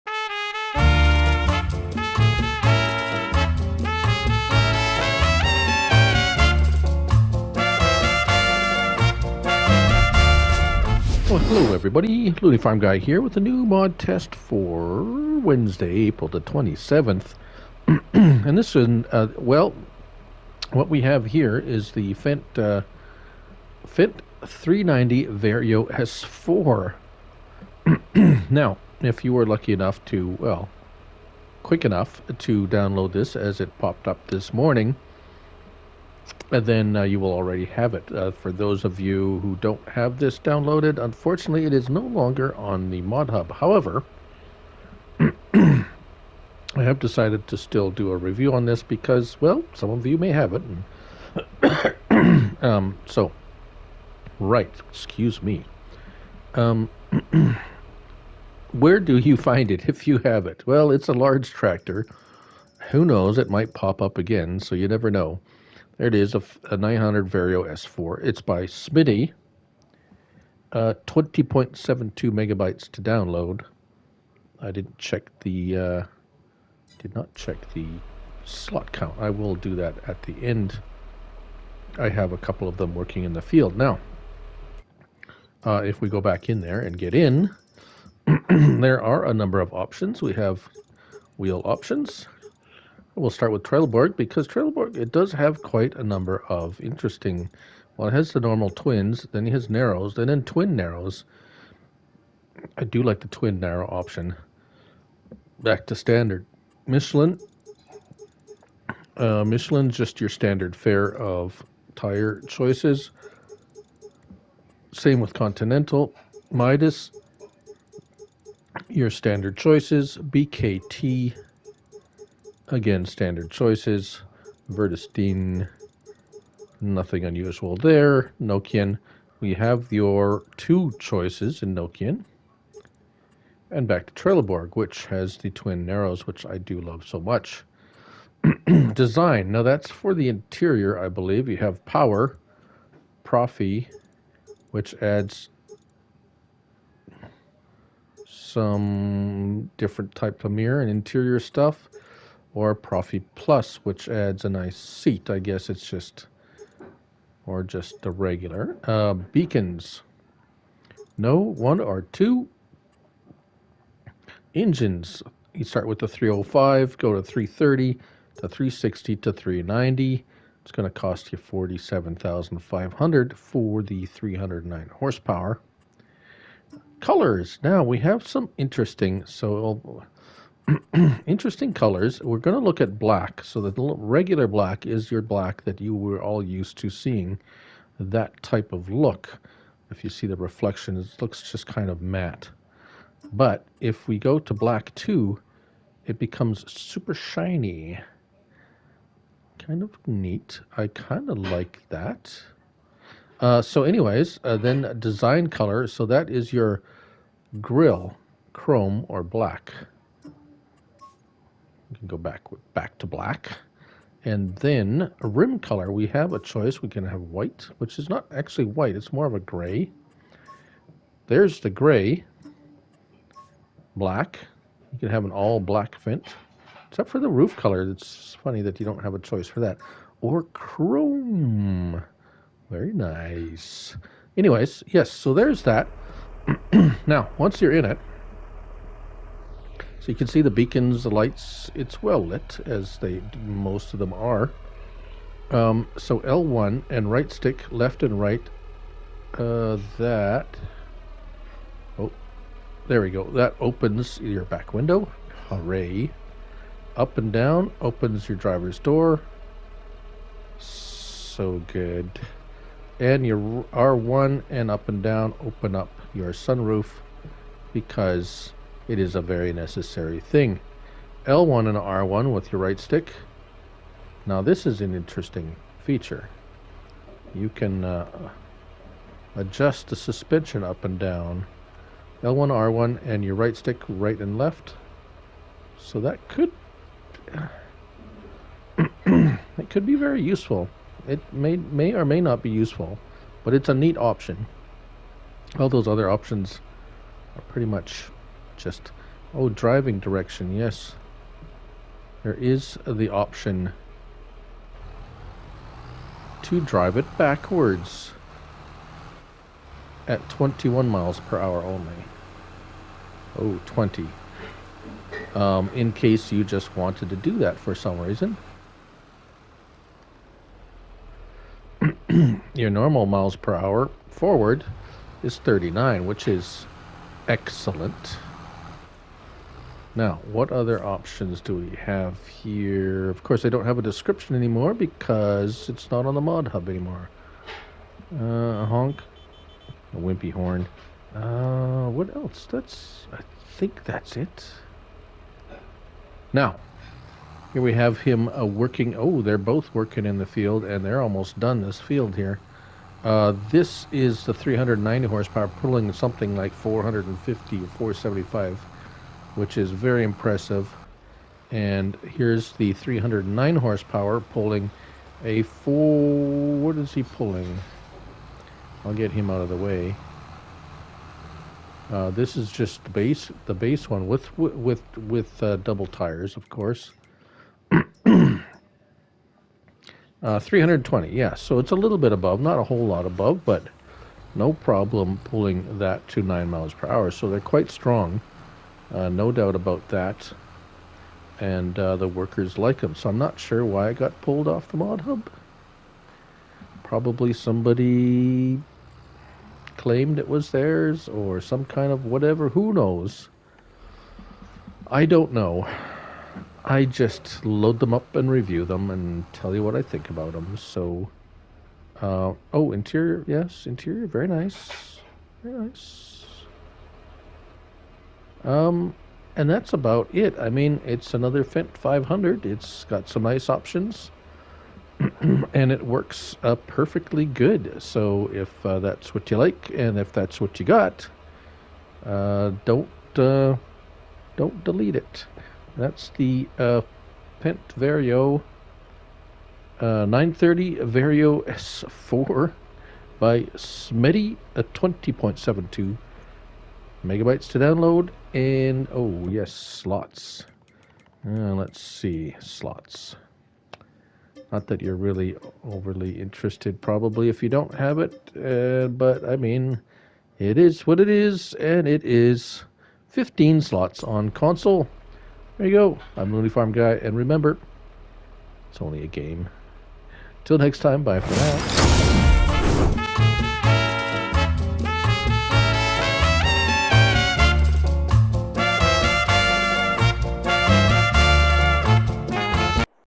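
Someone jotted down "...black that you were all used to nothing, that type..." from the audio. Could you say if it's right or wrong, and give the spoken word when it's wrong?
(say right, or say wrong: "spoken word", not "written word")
wrong: "seeing", not "nothing".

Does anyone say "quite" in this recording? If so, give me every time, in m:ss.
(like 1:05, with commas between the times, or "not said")
1:35, 6:27.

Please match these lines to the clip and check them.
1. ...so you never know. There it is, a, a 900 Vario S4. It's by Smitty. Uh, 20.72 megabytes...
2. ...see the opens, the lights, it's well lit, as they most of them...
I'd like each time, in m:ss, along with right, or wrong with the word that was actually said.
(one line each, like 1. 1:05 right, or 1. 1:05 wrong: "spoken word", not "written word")
1. 1:04 right
2. 4:00 wrong: "beacons", not "opens".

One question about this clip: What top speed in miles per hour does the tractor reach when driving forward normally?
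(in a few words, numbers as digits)
39.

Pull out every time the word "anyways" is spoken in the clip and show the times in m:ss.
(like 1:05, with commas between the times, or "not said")
3:23, 3:54.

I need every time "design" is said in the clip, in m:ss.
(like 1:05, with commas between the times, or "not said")
2:18, 3:24.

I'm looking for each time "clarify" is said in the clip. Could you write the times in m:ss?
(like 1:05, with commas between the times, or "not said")
not said.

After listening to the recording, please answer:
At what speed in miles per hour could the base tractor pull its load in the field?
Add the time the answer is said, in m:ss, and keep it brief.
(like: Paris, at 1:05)
9, at 6:26.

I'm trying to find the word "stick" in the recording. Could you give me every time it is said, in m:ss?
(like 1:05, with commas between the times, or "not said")
4:07, 4:32, 4:43.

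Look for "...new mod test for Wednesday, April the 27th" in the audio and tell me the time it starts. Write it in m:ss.
0:13.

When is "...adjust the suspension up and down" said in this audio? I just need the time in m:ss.
4:39.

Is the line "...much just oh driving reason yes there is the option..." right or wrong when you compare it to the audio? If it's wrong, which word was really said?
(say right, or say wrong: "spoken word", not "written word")
wrong: "direction", not "reason".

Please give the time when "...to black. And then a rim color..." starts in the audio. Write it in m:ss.
3:32.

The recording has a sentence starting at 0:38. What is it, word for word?
Uh, for those of you who don't have this downloaded, unfortunately, it is no longer on the Mod Hub.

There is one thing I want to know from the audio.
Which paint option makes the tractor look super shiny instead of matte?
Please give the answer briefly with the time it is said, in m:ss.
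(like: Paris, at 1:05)
Black 2, at 3:14.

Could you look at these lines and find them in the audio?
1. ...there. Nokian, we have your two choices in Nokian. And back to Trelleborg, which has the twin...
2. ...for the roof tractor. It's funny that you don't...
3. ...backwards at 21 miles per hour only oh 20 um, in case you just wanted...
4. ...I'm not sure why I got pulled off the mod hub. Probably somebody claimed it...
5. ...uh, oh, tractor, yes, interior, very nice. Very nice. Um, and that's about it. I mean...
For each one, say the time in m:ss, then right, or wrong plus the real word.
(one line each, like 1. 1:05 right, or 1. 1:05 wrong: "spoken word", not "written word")
1. 2:07 right
2. 3:47 wrong: "color", not "tractor"
3. 5:07 right
4. 6:33 right
5. 6:52 wrong: "interior", not "tractor".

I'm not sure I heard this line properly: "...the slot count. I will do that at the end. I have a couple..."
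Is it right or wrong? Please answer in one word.
right.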